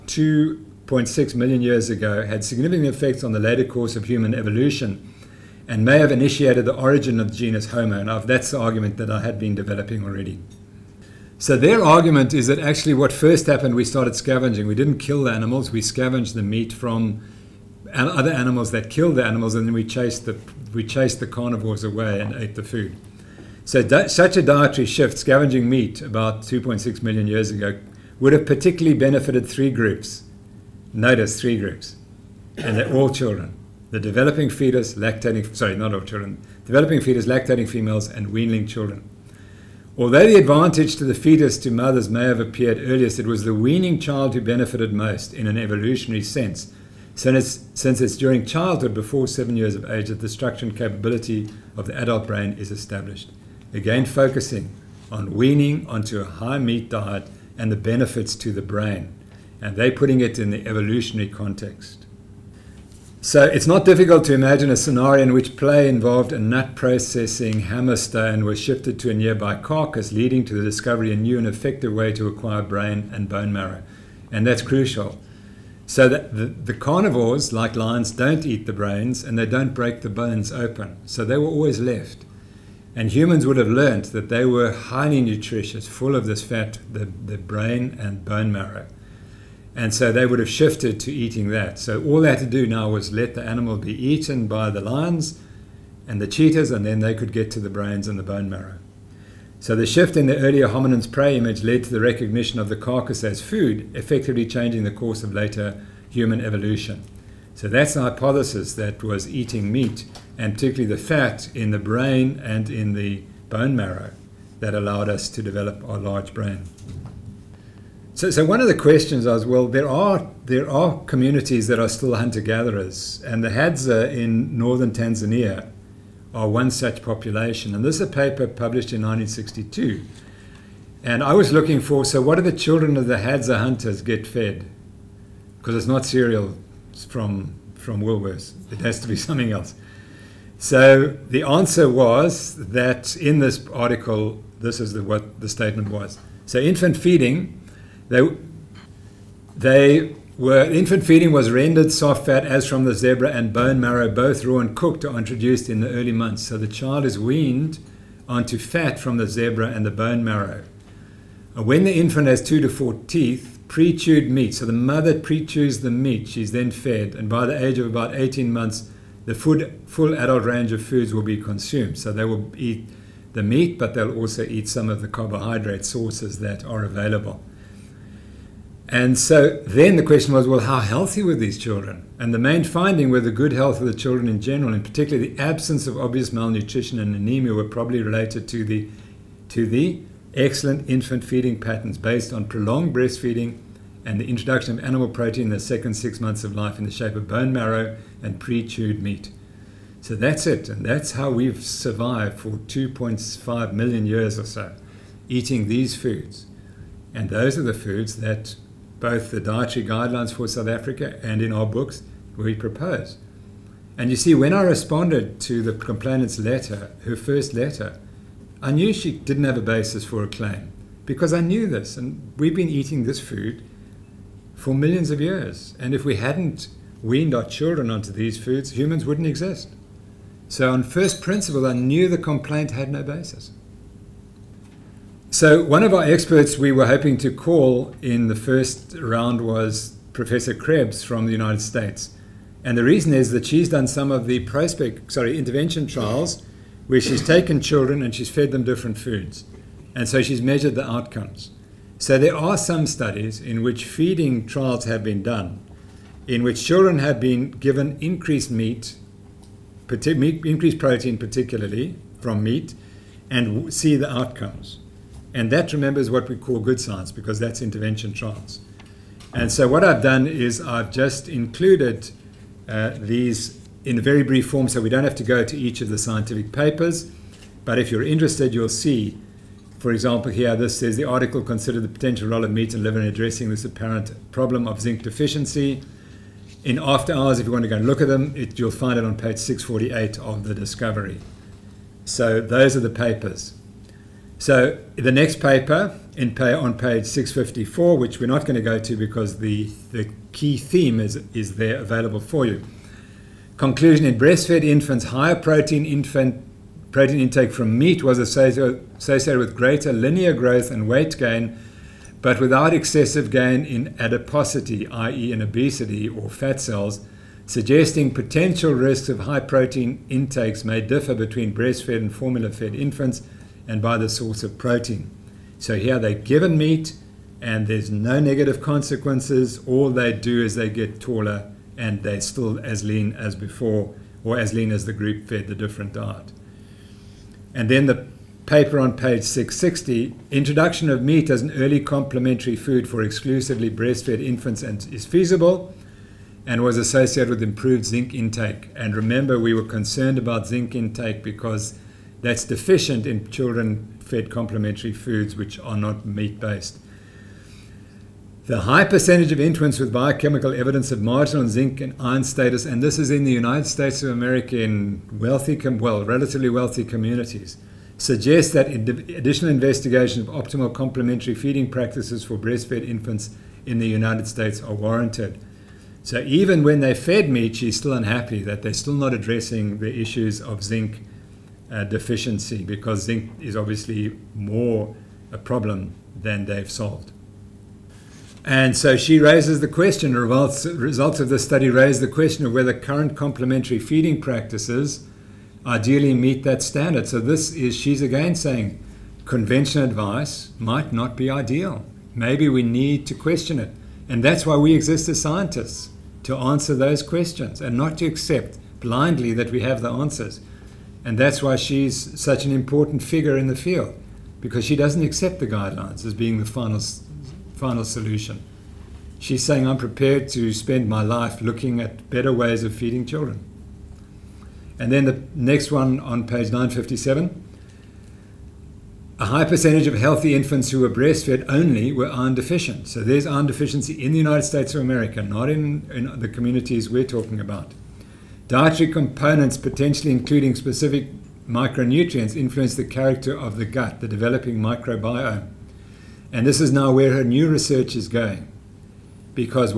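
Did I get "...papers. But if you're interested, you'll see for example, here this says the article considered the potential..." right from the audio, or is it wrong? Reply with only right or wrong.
right.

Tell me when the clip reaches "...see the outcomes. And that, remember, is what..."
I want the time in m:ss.
4:23.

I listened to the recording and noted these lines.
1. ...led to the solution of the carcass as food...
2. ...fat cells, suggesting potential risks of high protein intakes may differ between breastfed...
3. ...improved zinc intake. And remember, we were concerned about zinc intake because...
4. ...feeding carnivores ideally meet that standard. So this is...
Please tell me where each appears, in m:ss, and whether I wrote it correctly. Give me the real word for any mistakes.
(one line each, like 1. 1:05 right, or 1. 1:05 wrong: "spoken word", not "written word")
1. 1:41 wrong: "recognition", not "solution"
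2. 5:16 right
3. 5:47 right
4. 6:33 wrong: "practices", not "carnivores".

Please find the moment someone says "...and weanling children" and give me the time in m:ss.
0:38.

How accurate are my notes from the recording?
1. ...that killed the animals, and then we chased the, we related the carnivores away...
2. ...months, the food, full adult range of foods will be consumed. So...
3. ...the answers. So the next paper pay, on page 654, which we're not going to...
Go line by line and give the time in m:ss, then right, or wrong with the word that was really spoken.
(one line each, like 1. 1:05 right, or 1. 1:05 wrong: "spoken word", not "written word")
1. 0:18 wrong: "chased", not "related"
2. 2:48 right
3. 4:52 wrong: "papers", not "answers".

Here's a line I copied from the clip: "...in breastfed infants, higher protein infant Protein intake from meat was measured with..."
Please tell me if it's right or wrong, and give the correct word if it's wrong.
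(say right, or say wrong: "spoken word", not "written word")
wrong: "associated", not "measured".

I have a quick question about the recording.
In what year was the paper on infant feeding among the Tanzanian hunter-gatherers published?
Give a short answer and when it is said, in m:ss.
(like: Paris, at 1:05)
1962, at 2:09.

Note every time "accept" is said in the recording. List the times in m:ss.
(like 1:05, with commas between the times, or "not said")
6:48, 6:55.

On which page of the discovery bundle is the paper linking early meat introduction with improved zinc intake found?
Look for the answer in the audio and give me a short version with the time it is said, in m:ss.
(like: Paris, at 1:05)
660, at 5:38.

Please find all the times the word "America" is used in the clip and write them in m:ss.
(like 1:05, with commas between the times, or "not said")
6:04, 7:14.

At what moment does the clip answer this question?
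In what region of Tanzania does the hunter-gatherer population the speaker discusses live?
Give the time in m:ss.
2:04.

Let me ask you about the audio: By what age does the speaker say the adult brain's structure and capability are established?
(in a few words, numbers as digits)
7.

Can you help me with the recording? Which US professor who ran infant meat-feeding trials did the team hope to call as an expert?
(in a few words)
Professor Krebs.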